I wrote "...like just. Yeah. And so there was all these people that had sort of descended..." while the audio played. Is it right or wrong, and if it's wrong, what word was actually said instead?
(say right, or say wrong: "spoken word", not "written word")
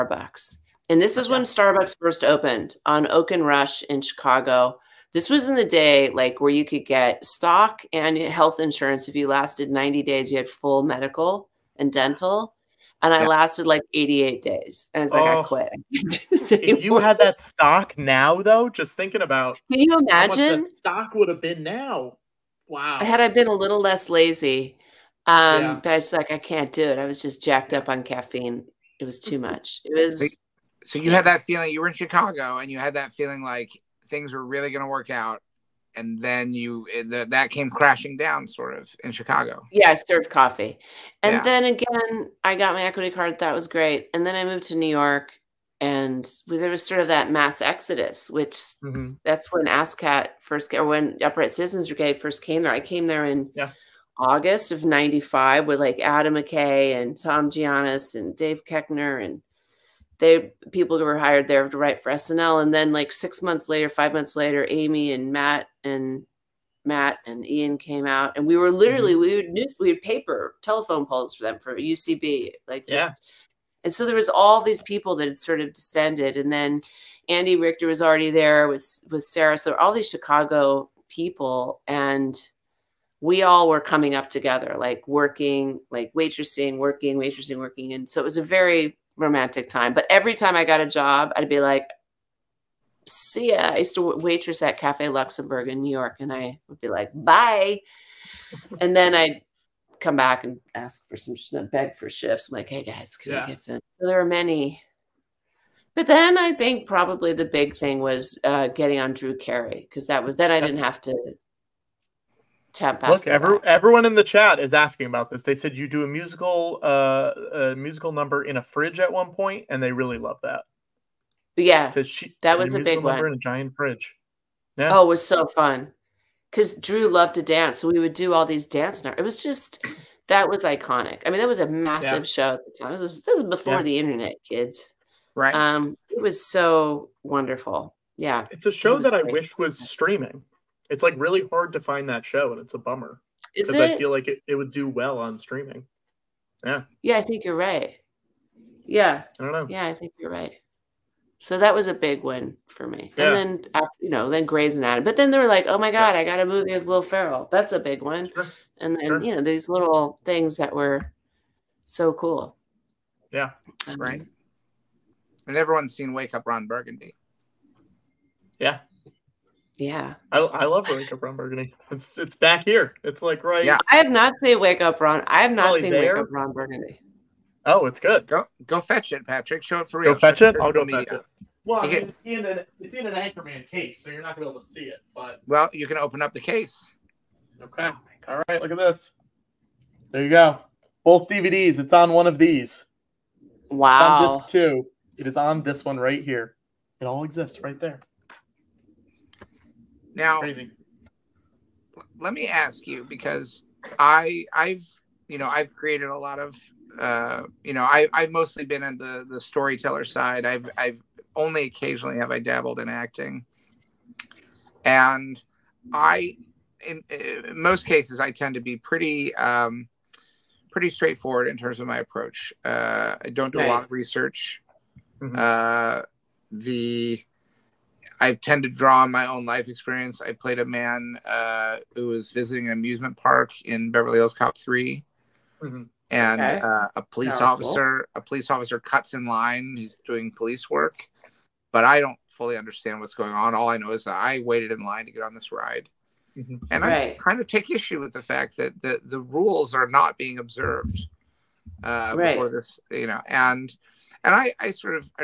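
right.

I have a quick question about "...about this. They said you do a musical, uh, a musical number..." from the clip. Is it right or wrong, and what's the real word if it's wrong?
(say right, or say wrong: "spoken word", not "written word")
right.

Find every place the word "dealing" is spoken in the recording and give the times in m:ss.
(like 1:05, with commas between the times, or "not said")
not said.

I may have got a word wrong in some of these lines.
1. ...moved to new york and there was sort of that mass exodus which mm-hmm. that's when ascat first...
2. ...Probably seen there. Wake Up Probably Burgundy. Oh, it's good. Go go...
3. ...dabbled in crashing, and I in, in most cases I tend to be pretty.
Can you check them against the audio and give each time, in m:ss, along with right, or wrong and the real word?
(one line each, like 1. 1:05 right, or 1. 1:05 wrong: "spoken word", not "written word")
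1. 0:44 right
2. 2:55 wrong: "Ron", not "Probably"
3. 3:32 wrong: "acting", not "crashing".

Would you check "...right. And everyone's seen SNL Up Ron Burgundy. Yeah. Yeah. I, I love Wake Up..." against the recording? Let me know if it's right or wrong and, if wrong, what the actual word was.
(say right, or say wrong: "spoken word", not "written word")
wrong: "Wake", not "SNL".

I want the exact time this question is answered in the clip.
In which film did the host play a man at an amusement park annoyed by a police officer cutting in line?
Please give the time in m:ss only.
3:53.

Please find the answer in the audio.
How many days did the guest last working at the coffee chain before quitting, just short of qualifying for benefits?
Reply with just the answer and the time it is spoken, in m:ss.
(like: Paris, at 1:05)
88, at 0:13.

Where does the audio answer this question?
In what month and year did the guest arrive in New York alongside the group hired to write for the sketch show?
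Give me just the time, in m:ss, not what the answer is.
0:54.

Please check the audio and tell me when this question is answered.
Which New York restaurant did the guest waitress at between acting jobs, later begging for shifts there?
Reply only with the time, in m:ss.
1:34.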